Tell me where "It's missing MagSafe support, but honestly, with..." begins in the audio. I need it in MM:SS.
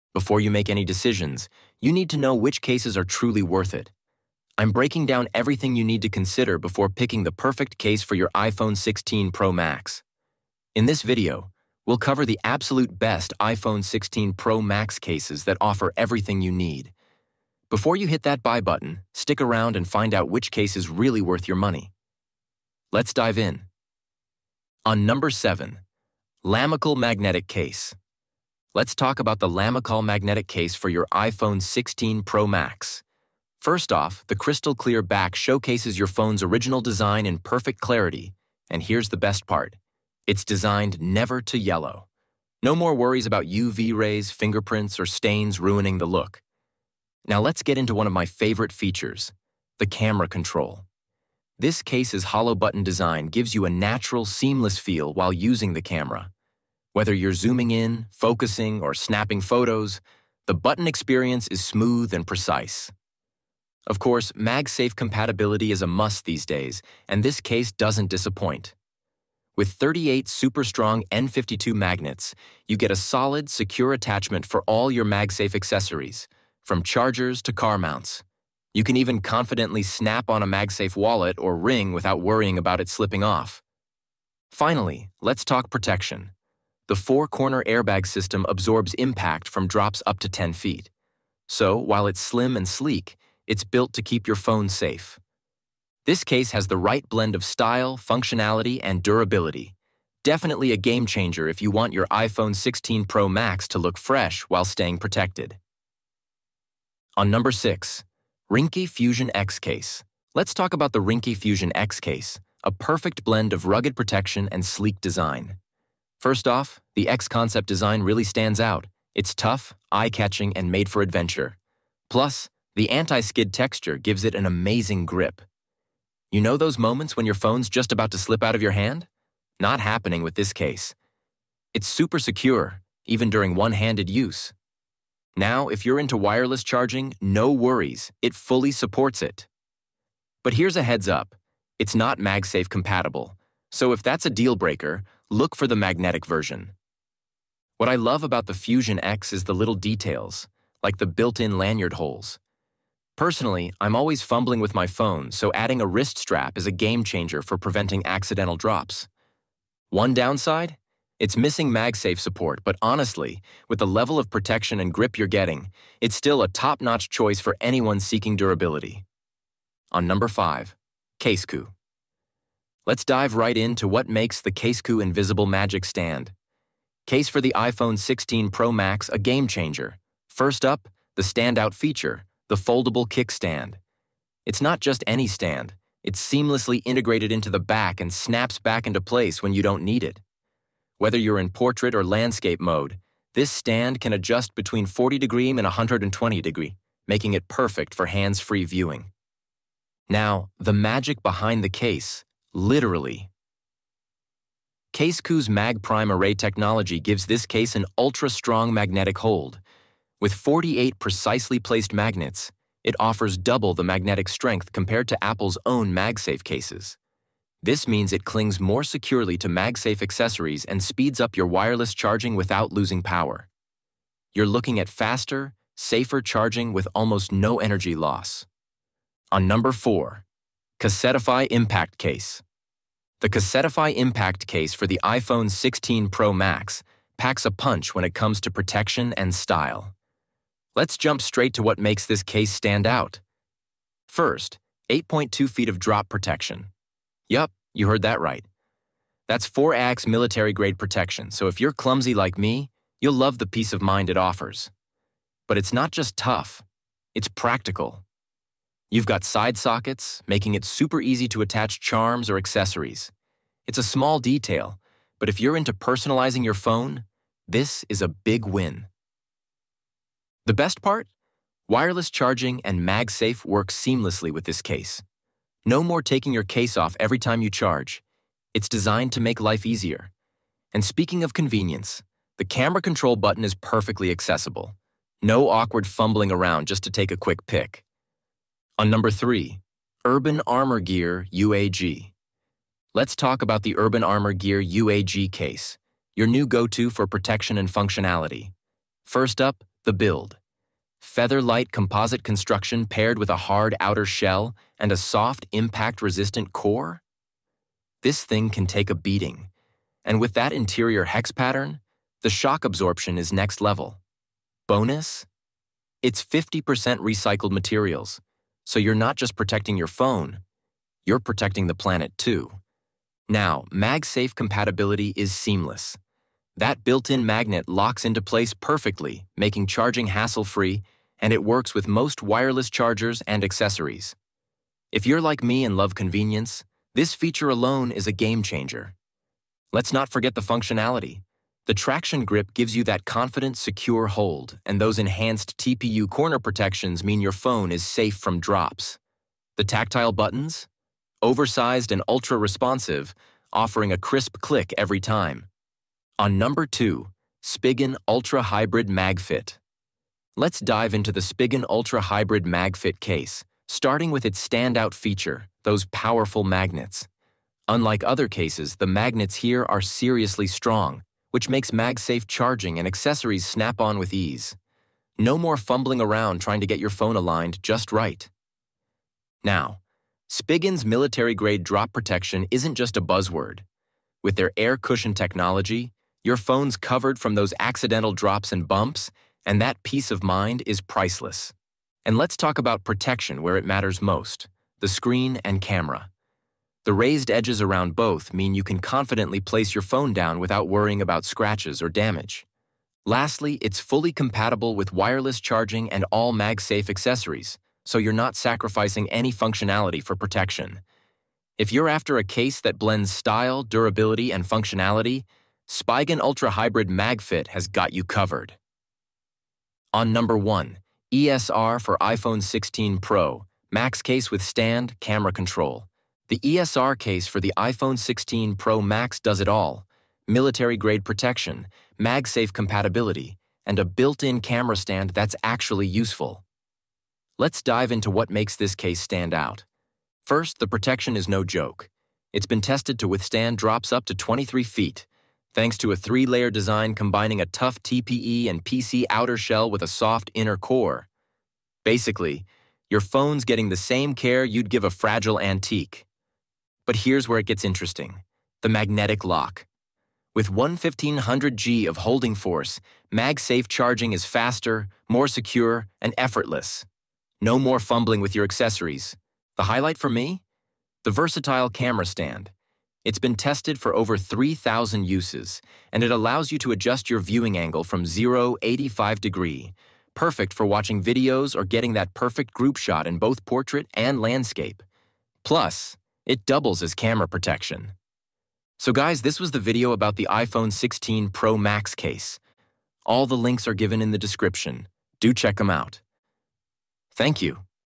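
02:41.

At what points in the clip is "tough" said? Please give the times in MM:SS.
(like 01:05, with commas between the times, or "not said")
01:59, 04:16, 07:27.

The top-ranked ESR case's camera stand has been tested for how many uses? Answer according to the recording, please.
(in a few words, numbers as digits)
Over 3,000.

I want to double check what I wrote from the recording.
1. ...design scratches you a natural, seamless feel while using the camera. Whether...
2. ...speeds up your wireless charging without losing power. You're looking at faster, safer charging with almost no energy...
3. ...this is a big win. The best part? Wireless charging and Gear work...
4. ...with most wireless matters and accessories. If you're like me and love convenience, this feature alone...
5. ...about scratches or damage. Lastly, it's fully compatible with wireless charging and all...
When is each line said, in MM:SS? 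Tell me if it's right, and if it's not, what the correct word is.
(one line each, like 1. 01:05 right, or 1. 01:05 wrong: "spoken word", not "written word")
1. 00:52 wrong: "gives", not "scratches"
2. 03:40 right
3. 04:27 wrong: "MagSafe", not "Gear"
4. 05:31 wrong: "chargers", not "matters"
5. 06:40 right.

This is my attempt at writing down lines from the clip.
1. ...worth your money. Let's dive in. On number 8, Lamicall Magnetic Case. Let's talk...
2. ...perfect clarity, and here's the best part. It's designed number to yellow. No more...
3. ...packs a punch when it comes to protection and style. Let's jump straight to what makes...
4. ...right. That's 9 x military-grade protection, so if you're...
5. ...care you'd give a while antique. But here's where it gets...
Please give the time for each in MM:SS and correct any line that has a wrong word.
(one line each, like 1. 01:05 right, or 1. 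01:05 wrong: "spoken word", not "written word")
1. 00:21 wrong: "7", not "8"
2. 00:37 wrong: "never", not "number"
3. 03:57 right
4. 04:08 wrong: "4", not "9"
5. 07:34 wrong: "fragile", not "while".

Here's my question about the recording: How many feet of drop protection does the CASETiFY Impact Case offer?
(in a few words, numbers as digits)
8.2 feet.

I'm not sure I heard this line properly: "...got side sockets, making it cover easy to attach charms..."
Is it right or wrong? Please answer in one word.
wrong.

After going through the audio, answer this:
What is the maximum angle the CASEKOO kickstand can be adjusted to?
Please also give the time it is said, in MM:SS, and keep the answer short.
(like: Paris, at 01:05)
120 degrees, at 03:15.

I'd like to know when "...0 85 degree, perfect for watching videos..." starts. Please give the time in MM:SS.
07:58.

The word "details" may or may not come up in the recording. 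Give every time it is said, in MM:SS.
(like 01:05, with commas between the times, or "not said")
02:29, 04:24.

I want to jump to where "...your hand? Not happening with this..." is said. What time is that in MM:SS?
02:08.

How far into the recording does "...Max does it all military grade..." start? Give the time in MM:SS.
07:08.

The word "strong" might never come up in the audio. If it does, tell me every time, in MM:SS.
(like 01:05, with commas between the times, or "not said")
01:10, 03:27, 06:10.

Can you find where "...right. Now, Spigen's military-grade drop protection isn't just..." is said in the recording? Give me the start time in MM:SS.
06:17.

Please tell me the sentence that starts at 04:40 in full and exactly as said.
And speaking of convenience, the camera control button is perfectly accessible.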